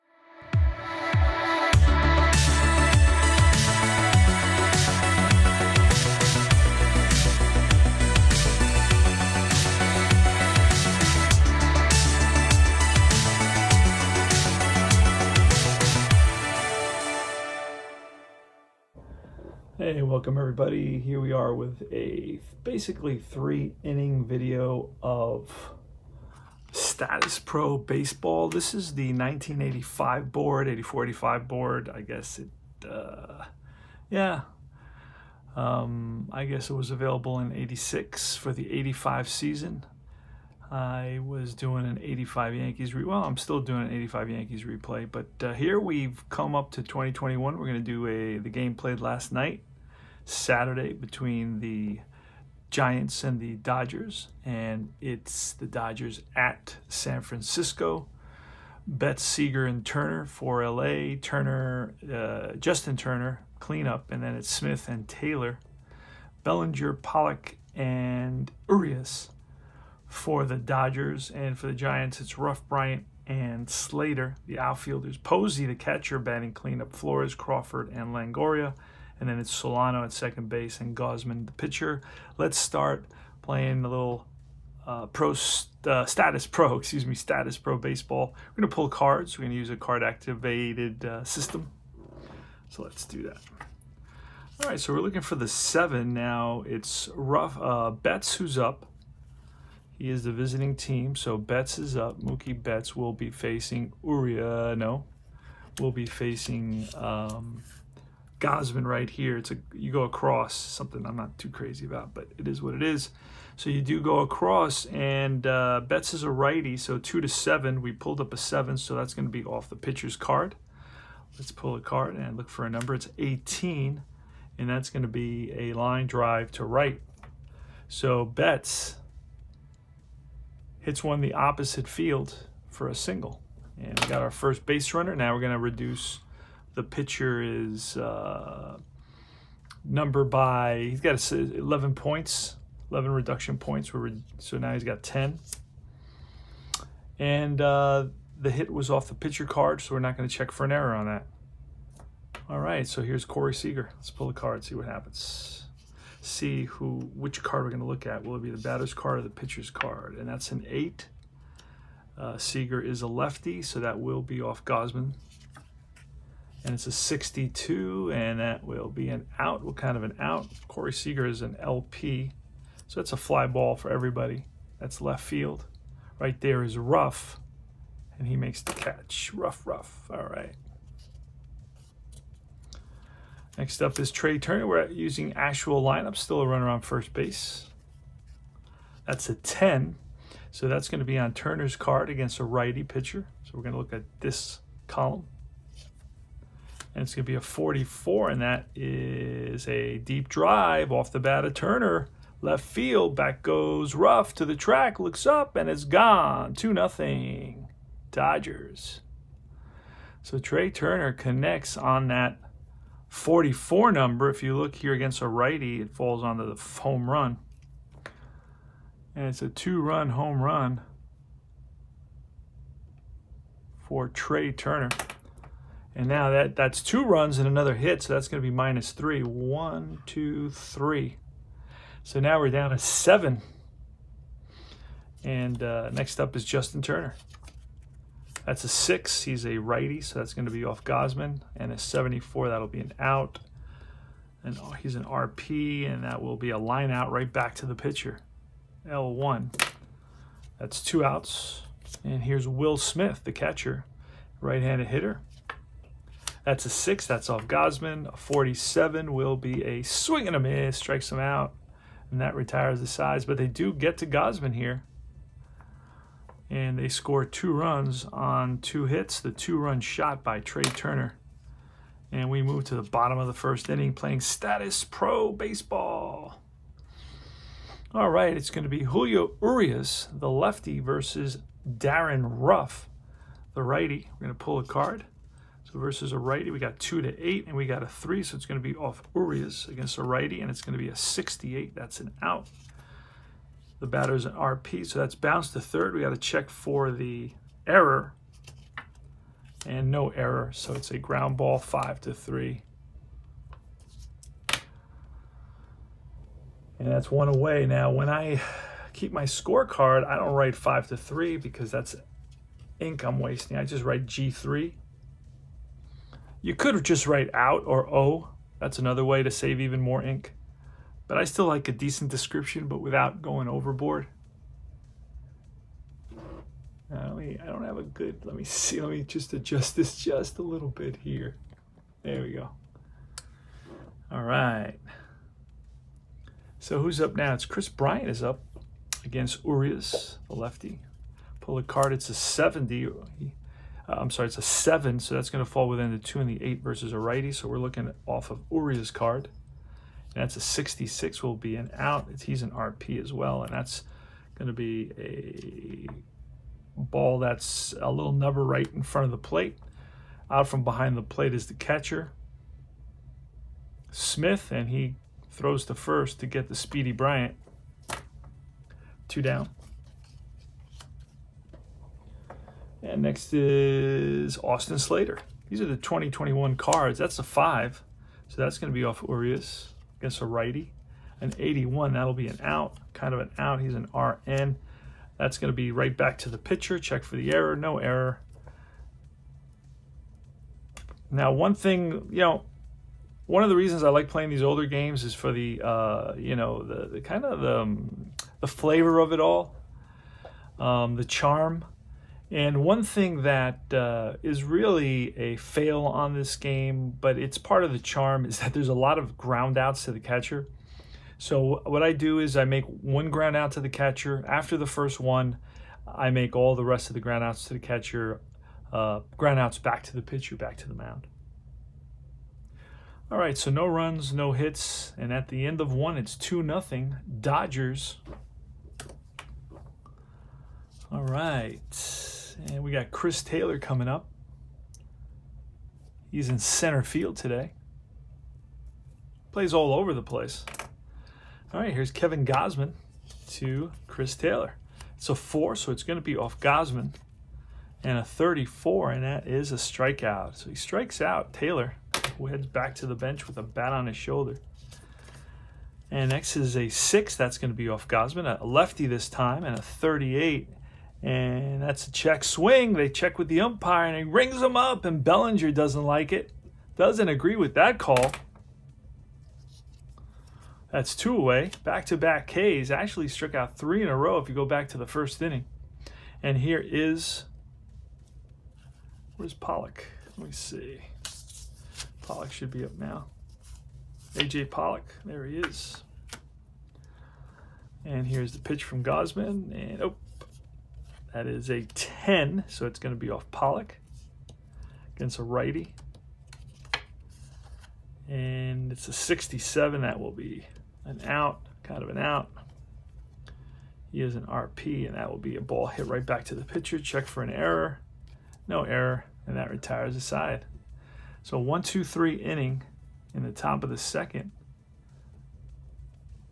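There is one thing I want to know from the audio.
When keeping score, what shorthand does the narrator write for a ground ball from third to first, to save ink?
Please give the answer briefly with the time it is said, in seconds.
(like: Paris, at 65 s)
G3, at 314 s.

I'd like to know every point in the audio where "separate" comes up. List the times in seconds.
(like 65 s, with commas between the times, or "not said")
not said.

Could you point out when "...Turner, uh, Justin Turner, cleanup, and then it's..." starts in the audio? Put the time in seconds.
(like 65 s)
61 s.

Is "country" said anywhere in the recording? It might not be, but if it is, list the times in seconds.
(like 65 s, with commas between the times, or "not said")
not said.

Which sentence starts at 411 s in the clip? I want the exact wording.
So what I do is I make one ground out to the catcher.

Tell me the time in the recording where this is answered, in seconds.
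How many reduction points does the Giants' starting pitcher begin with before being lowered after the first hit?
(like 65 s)
142 s.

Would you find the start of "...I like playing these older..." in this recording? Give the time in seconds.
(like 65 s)
393 s.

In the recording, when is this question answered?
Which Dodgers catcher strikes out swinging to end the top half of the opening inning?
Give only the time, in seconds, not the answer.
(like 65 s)
252 s.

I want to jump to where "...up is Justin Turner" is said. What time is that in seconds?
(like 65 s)
236 s.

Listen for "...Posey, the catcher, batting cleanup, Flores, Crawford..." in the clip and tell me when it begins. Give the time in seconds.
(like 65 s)
75 s.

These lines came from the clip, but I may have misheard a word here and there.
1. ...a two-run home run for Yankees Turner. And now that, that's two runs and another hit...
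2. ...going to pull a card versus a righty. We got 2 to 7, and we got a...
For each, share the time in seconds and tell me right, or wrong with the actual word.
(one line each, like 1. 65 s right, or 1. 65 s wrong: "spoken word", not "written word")
1. 219 s wrong: "Trea", not "Yankees"
2. 284 s wrong: "8", not "7".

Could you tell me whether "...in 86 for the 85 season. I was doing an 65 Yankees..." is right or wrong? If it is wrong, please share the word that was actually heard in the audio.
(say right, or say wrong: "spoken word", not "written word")
wrong: "85", not "65".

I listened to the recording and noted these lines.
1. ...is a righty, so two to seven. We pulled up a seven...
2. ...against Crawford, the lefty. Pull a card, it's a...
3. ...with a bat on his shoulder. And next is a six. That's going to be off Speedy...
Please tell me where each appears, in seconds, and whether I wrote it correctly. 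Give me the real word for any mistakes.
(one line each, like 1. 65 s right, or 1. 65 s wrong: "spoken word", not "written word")
1. 116 s right
2. 339 s wrong: "Urias", not "Crawford"
3. 453 s wrong: "Gausman", not "Speedy".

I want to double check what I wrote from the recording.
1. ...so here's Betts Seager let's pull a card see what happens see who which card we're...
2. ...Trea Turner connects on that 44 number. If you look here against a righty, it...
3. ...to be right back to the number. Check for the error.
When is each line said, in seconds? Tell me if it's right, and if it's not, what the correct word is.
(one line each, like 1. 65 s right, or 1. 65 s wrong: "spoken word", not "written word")
1. 152 s wrong: "Corey", not "Betts"
2. 210 s right
3. 385 s wrong: "pitcher", not "number".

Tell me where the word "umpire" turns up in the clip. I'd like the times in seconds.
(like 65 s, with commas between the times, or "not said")
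463 s.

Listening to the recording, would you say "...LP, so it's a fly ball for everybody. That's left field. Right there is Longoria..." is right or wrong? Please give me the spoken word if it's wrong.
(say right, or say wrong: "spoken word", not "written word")
wrong: "Ruf", not "Longoria".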